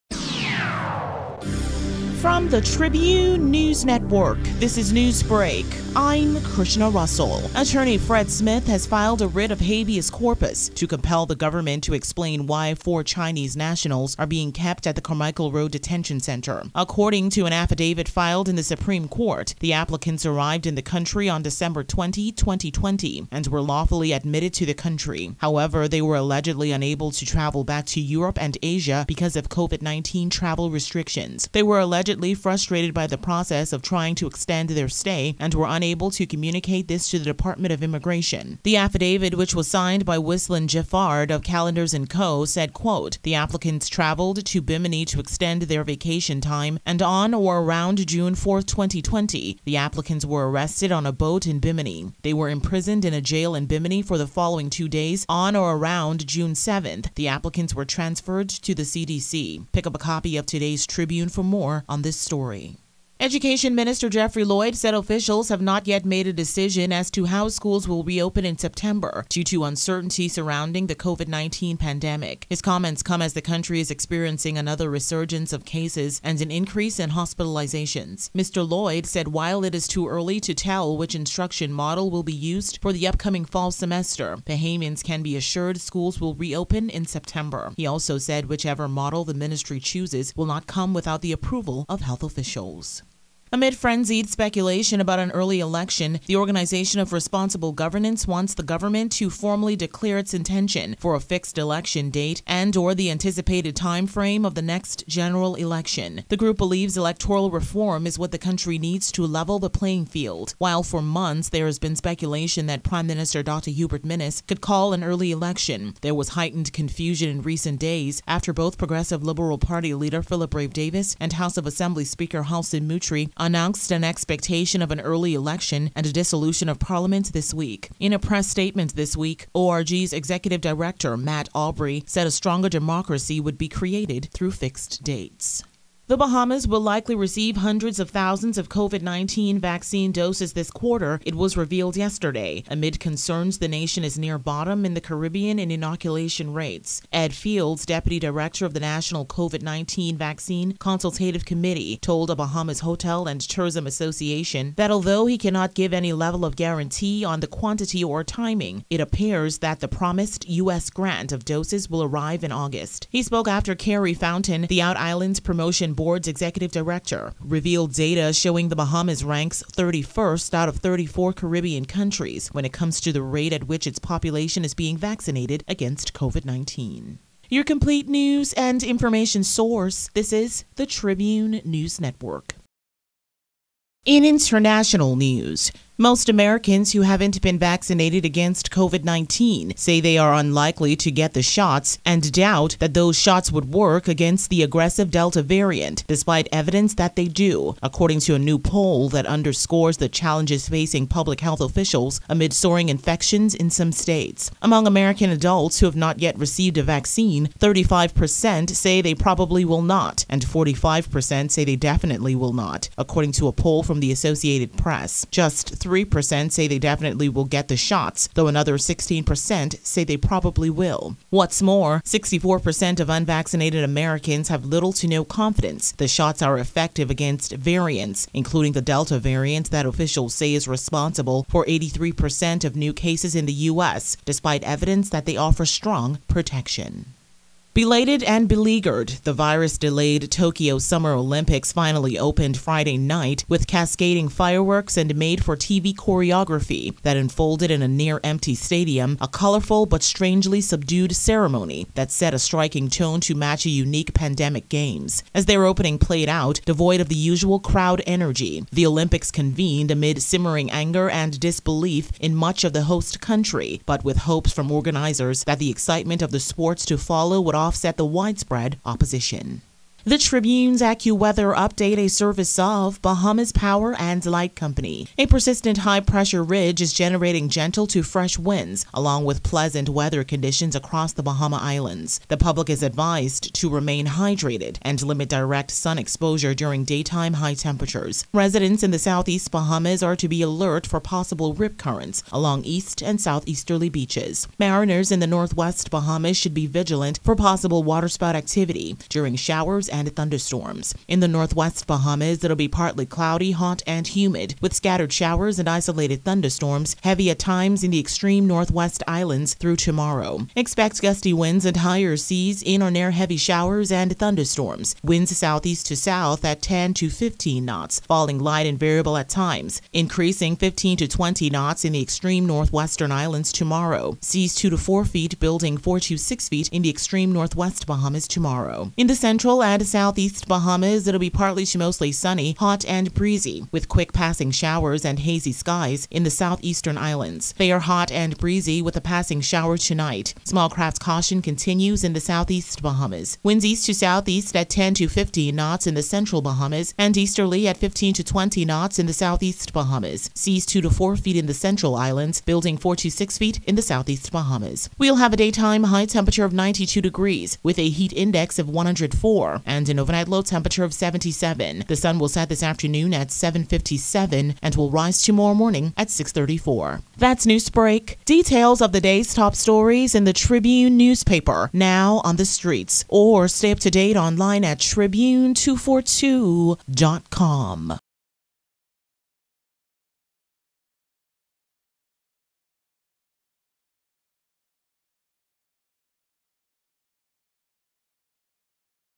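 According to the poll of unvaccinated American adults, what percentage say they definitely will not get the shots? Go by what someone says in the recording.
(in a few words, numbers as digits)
45%.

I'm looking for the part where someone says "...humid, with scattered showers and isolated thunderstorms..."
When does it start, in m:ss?
5:04.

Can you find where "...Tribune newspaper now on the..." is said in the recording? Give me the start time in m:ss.
6:10.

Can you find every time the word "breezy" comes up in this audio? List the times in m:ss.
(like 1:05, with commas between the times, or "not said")
5:33, 5:38.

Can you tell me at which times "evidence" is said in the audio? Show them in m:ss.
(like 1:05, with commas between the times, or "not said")
3:16, 3:54.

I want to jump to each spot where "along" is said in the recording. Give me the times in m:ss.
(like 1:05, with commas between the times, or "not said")
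4:38, 4:52.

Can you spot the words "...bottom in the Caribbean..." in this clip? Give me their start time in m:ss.
2:24.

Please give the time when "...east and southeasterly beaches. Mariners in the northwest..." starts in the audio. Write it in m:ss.
4:52.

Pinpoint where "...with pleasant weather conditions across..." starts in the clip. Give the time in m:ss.
4:39.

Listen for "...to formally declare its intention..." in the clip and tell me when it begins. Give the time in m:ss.
1:39.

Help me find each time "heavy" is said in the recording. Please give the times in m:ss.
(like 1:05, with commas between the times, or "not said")
5:07, 5:13.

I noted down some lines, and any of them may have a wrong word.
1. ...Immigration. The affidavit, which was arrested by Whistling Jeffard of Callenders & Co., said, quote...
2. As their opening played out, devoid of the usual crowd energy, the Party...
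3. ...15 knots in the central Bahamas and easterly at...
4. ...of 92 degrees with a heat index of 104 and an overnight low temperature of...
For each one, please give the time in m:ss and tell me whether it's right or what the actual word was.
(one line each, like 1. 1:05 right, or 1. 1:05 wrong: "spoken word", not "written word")
1. 0:37 wrong: "signed", not "arrested"
2. 4:15 wrong: "Olympics", not "Party"
3. 5:45 right
4. 5:56 right.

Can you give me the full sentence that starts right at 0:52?
They were imprisoned in a jail in Bimini for the following two days on or around June 7th.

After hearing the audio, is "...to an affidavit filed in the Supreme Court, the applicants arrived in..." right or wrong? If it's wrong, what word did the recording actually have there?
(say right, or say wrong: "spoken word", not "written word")
right.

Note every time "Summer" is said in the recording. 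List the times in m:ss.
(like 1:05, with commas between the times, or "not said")
4:00.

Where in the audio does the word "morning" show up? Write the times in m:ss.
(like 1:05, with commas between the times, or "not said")
6:05.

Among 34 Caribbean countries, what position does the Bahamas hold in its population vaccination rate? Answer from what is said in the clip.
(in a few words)
31st.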